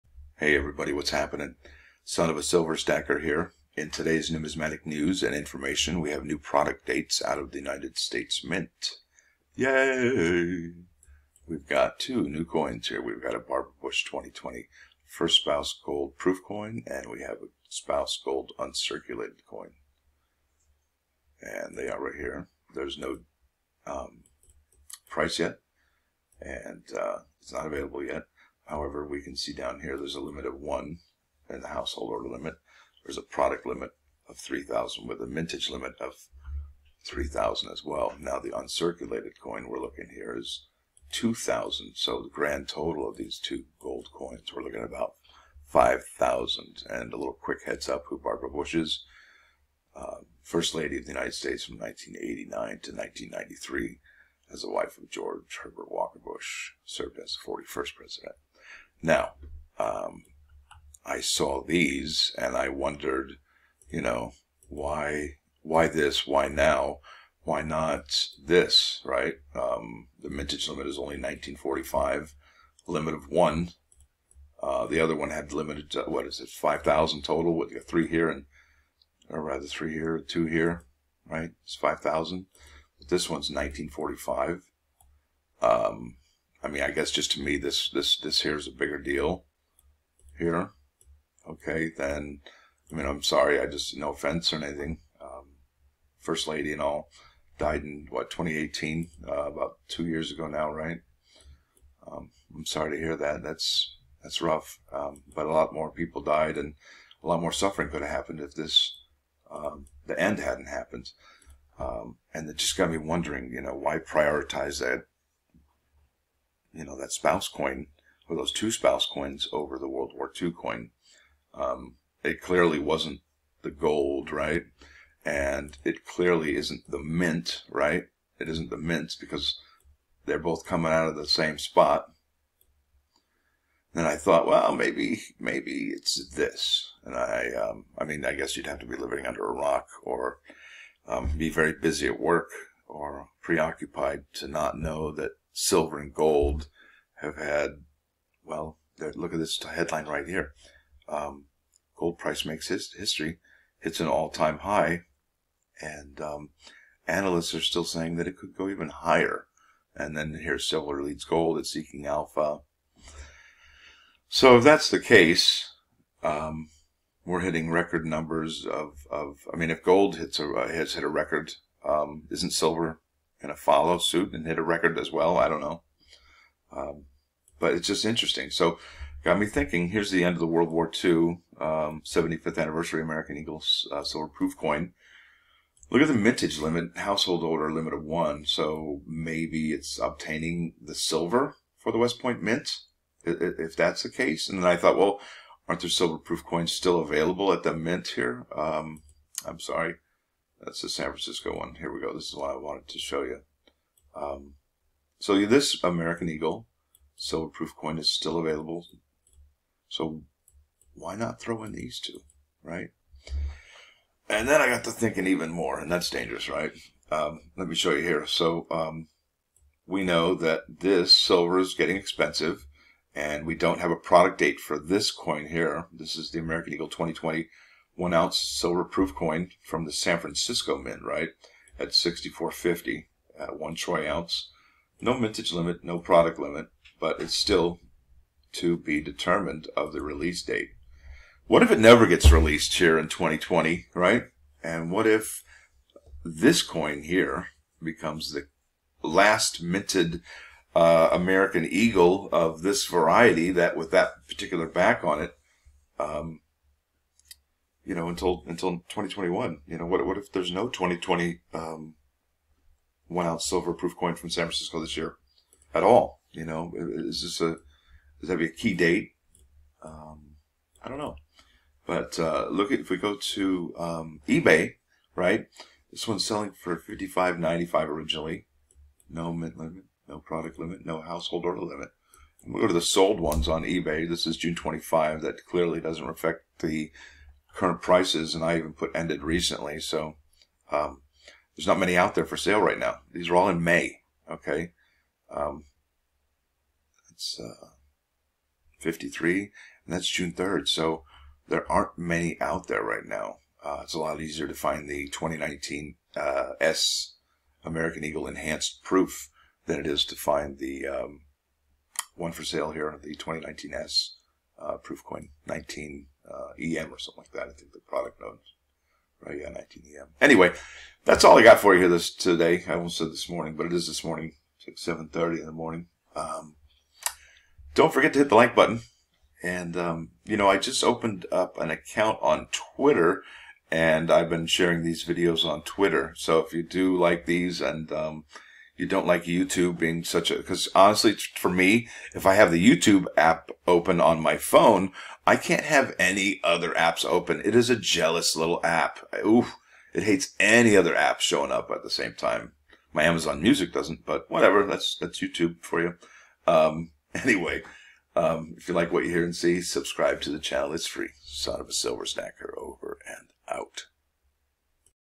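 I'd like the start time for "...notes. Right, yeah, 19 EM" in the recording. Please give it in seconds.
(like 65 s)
318 s.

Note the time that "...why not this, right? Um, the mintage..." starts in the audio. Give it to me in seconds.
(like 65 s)
67 s.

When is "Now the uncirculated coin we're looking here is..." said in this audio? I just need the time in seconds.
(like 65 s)
38 s.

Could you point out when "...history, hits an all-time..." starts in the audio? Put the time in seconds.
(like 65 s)
152 s.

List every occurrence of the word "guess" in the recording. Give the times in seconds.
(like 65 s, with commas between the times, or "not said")
86 s, 138 s.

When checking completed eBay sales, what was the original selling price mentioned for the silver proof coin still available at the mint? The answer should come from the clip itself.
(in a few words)
$55.95.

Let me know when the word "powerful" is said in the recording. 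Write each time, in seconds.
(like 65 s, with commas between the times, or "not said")
not said.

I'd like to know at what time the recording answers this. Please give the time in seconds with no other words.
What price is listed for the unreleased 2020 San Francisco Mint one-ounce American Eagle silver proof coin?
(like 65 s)
231 s.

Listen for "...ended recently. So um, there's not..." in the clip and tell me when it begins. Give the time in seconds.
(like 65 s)
288 s.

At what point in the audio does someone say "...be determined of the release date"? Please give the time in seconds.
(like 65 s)
238 s.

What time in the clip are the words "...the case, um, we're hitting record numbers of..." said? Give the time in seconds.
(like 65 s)
164 s.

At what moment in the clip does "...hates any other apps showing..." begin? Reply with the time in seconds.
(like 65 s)
350 s.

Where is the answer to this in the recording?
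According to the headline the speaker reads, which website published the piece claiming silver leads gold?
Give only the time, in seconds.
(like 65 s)
161 s.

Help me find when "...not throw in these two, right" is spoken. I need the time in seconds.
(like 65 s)
211 s.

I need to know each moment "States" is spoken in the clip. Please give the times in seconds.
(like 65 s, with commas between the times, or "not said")
7 s, 51 s.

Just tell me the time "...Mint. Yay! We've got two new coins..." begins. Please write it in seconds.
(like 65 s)
8 s.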